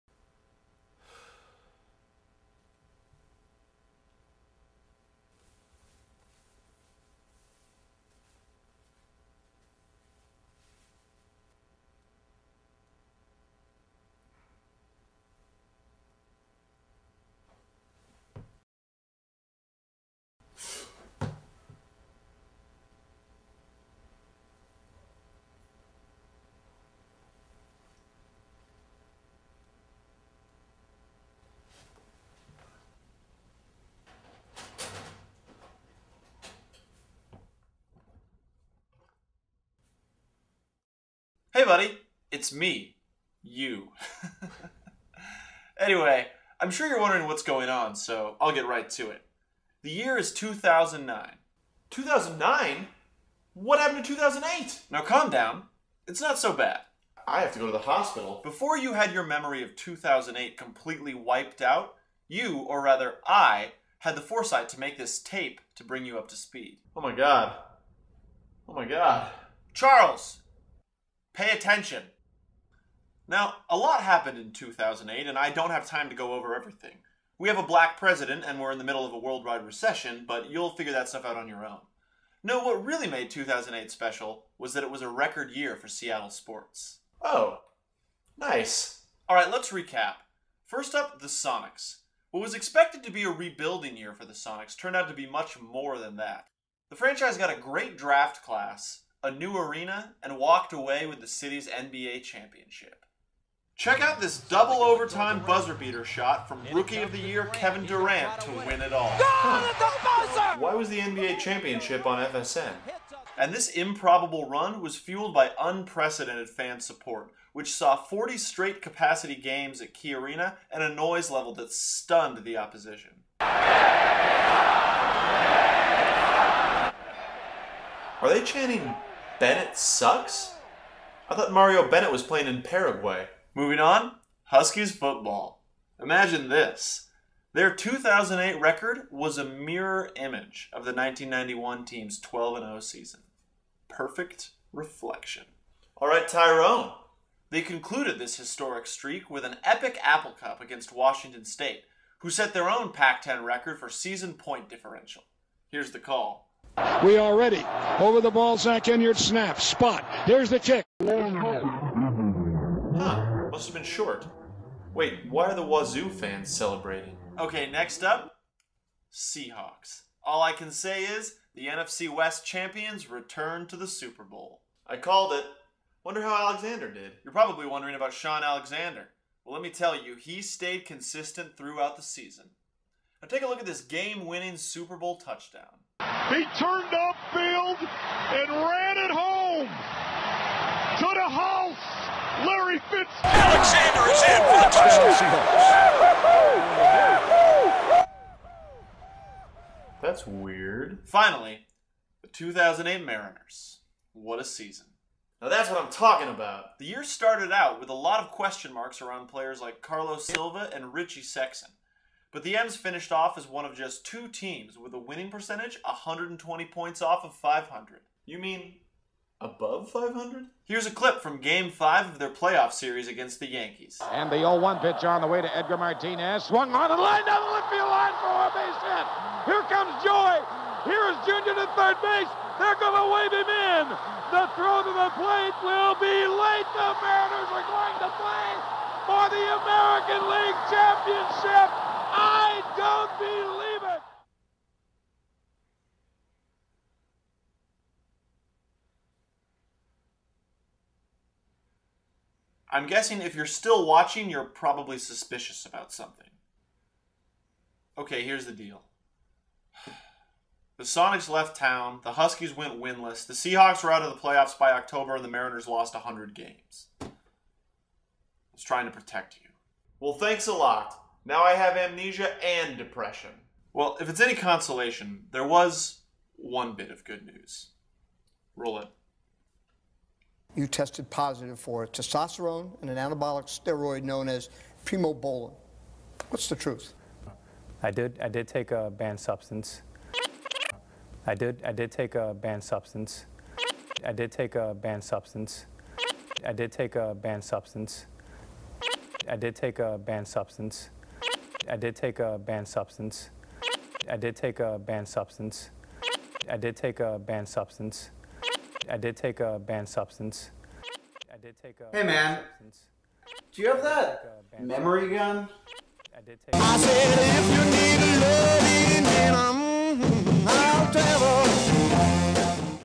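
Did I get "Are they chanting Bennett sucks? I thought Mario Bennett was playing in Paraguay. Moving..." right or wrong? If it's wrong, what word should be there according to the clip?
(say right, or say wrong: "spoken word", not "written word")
right.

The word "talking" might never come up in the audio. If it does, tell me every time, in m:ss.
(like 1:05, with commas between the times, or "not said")
3:25.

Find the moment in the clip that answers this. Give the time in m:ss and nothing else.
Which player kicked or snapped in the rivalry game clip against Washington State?
2:38.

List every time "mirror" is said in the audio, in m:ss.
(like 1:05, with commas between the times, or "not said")
2:19.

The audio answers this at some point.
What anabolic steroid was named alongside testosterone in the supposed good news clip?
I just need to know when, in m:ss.
4:44.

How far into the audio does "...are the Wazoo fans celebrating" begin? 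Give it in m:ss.
2:45.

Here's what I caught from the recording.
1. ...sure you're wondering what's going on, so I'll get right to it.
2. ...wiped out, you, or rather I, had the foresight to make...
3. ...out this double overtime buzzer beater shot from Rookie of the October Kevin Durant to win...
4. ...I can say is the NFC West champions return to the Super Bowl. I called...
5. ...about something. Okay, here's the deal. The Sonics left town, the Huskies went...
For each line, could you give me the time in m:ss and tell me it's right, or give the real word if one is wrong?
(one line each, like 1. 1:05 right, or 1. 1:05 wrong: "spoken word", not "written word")
1. 0:46 right
2. 1:01 right
3. 1:44 wrong: "Year", not "October"
4. 2:50 right
5. 4:15 right.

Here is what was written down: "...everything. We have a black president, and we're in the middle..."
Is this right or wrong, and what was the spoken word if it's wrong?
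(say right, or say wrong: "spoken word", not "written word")
right.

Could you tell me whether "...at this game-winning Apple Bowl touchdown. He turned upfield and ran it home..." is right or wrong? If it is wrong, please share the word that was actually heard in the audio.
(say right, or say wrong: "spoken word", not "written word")
wrong: "Super", not "Apple".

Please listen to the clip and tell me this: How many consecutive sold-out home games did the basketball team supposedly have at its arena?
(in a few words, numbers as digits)
40.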